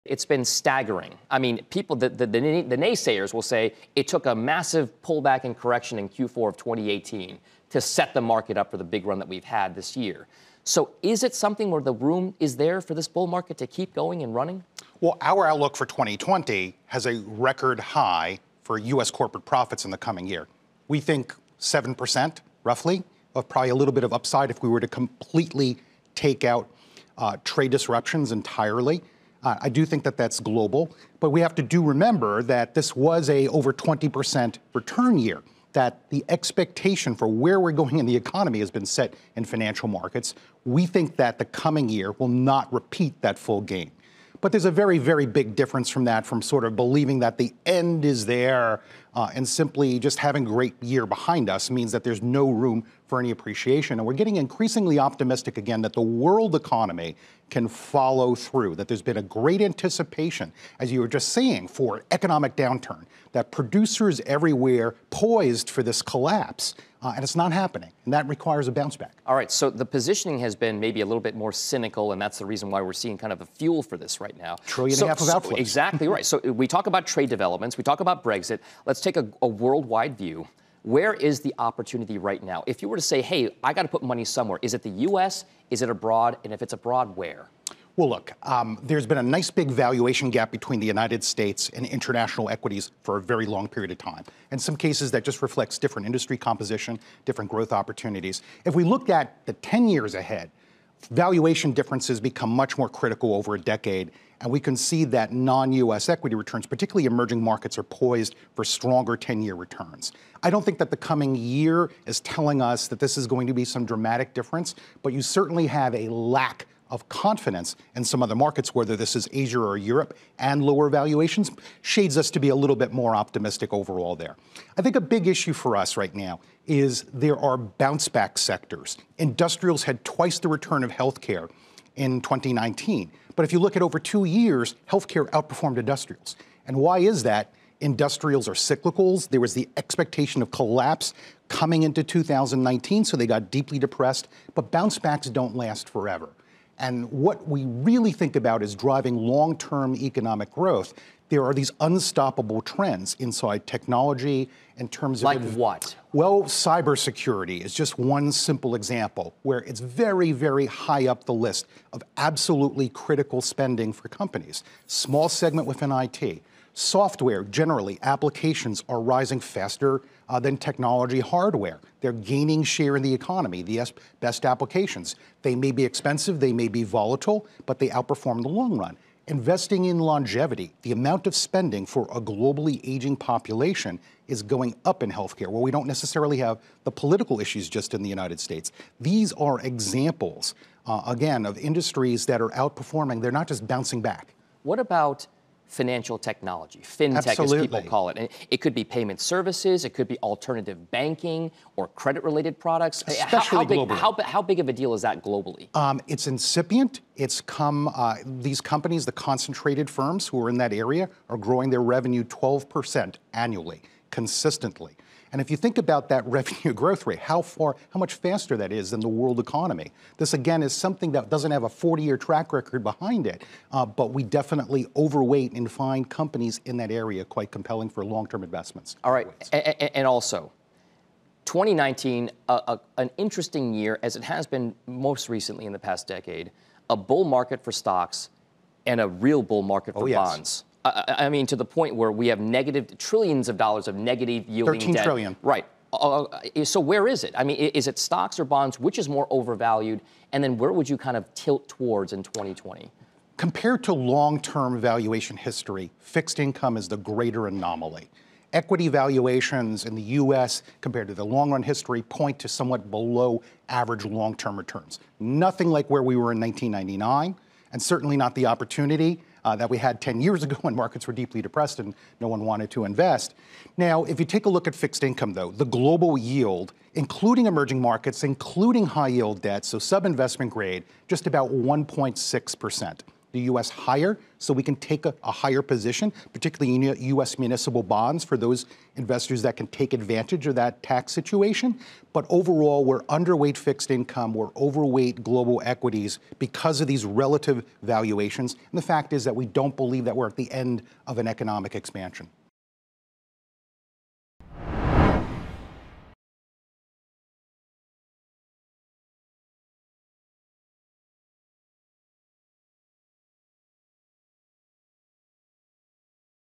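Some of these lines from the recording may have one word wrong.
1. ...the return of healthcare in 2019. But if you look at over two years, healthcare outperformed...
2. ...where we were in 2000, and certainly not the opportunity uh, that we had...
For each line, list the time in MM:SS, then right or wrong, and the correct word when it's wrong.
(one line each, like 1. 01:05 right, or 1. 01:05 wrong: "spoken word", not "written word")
1. 02:10 right
2. 04:25 wrong: "1999", not "2000".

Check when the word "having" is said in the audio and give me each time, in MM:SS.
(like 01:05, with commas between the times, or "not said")
00:50.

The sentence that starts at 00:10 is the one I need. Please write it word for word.
So is it something where the room is there for this bull market to keep going and running?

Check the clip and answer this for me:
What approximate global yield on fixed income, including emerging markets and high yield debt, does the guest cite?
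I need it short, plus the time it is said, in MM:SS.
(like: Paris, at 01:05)
1.6%, at 04:41.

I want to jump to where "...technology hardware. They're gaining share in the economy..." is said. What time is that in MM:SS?
02:50.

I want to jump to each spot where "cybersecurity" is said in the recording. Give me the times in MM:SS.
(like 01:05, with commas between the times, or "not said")
02:36.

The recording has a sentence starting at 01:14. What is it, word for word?
Trillion so, and a half of outflows.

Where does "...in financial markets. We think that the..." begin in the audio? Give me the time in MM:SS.
00:39.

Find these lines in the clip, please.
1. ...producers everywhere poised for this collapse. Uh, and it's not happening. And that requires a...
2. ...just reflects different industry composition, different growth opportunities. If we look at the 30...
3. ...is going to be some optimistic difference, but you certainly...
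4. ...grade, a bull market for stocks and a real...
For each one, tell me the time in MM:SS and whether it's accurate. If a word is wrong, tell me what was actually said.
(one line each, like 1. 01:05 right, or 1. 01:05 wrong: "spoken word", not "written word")
1. 01:03 right
2. 01:35 wrong: "10", not "30"
3. 01:53 wrong: "dramatic", not "optimistic"
4. 03:56 wrong: "decade", not "grade".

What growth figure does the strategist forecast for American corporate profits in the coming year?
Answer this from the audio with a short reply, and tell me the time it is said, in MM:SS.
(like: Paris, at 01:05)
7%, at 00:21.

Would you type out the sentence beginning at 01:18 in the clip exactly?
Let's take a, a worldwide view.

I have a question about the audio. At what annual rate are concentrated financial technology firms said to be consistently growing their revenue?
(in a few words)
12%.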